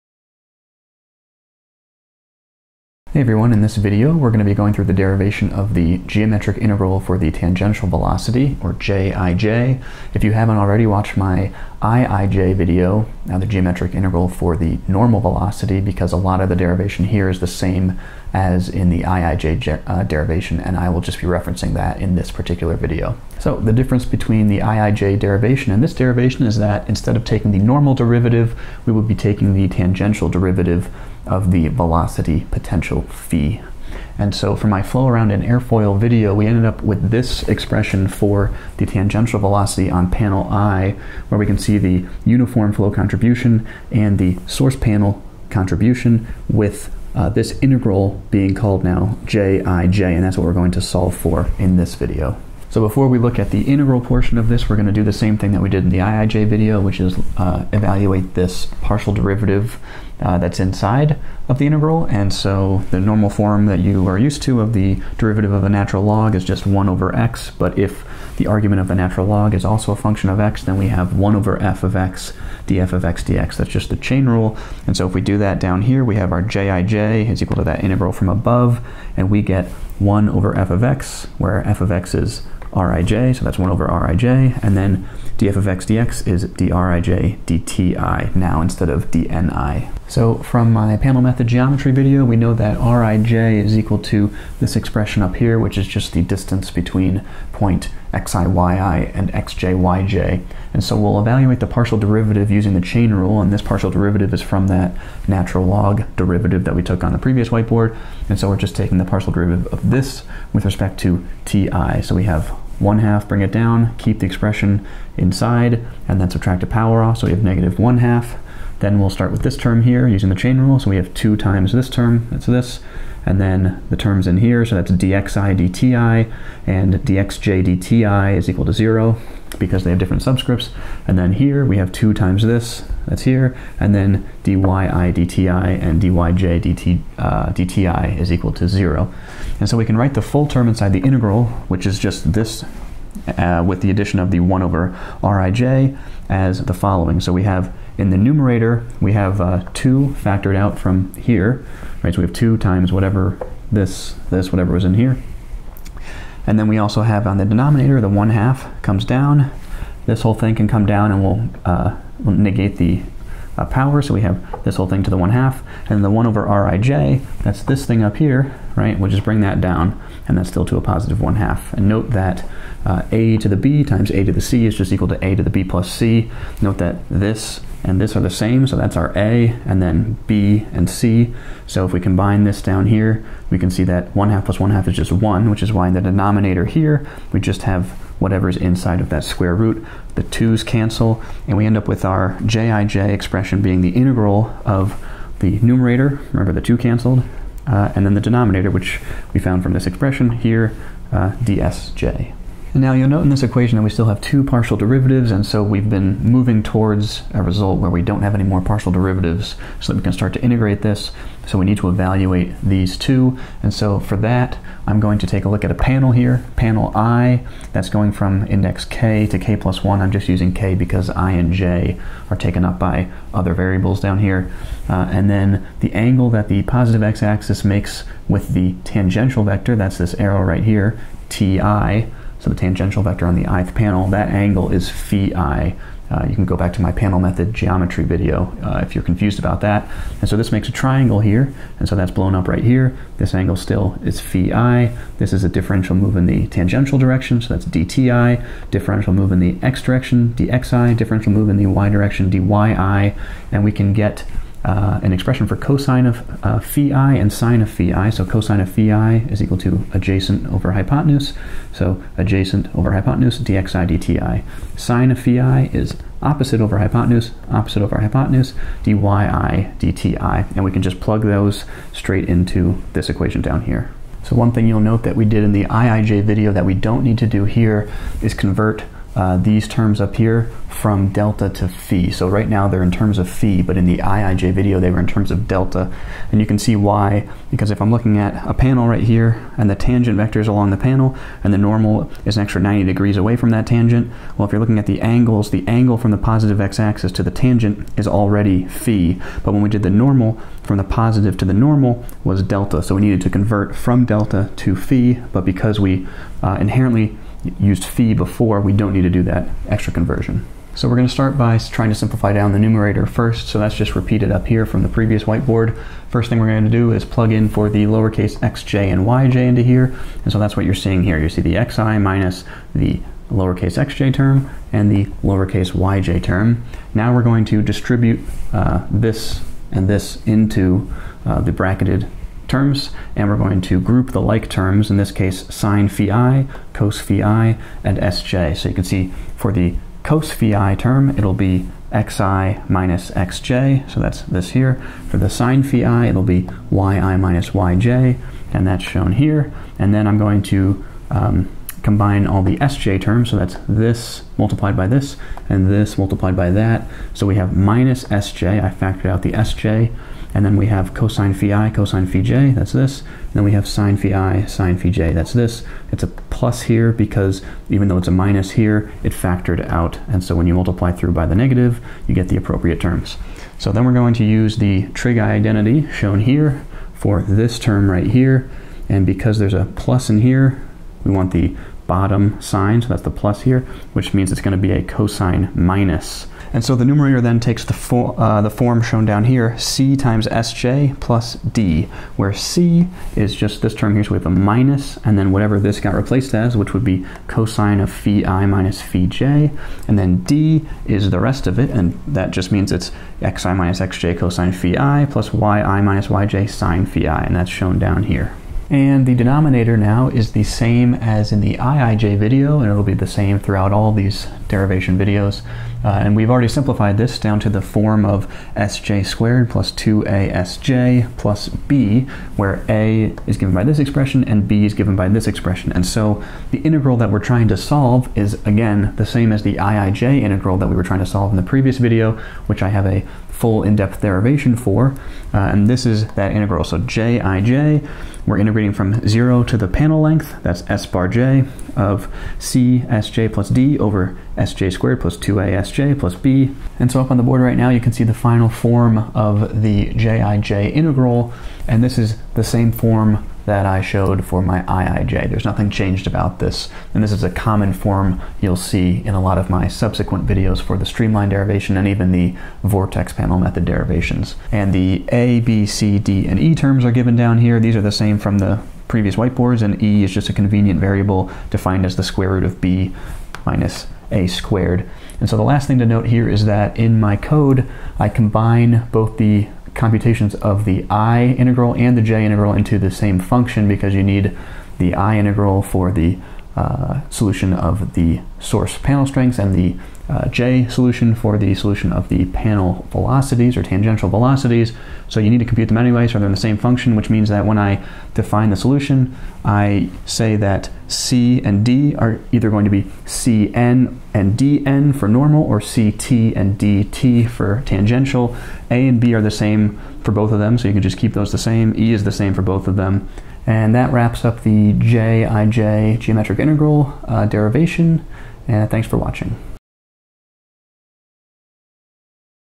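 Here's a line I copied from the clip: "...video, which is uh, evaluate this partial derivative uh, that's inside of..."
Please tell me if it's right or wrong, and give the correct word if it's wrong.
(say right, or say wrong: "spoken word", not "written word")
right.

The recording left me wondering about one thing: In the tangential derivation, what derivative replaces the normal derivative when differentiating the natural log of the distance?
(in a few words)
drij dti.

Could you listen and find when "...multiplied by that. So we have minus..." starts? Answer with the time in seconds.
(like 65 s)
355 s.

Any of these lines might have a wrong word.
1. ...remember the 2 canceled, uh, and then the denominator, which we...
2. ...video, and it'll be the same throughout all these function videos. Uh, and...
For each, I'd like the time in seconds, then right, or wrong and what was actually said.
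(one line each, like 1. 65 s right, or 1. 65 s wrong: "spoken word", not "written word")
1. 196 s right
2. 412 s wrong: "derivation", not "function".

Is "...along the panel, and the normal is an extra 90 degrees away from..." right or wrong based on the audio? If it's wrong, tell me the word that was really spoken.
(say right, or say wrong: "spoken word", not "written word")
right.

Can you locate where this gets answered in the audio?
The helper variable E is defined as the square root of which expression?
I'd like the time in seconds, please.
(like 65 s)
472 s.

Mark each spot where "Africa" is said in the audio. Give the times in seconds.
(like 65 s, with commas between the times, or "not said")
not said.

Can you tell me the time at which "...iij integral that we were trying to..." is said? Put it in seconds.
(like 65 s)
429 s.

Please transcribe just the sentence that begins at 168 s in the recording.
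We'll just bring that down, and that's still to a positive 1 half.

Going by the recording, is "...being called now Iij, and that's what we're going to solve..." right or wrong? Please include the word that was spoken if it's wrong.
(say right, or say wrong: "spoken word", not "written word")
wrong: "Jij", not "Iij".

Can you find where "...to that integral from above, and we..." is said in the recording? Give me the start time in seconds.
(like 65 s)
77 s.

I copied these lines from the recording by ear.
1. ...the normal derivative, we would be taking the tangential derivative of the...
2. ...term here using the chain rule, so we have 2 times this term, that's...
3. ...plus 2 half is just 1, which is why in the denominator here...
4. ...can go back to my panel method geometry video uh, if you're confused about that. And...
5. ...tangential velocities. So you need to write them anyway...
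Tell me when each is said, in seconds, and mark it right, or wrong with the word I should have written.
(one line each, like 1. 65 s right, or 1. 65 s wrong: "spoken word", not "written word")
1. 27 s right
2. 119 s right
3. 184 s wrong: "1", not "2"
4. 236 s right
5. 493 s wrong: "compute", not "write".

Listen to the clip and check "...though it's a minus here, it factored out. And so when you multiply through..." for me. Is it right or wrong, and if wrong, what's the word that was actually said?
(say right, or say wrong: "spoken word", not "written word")
right.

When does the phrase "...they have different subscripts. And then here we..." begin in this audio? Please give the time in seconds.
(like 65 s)
129 s.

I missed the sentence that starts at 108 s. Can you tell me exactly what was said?
And so we're just taking the partial derivative of this with respect to ti.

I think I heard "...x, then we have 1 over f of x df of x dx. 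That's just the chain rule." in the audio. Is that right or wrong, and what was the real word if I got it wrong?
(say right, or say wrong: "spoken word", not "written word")
right.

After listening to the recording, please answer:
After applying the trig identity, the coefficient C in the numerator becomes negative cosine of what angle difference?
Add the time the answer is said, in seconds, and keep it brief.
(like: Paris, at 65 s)
phi i minus phi j, at 397 s.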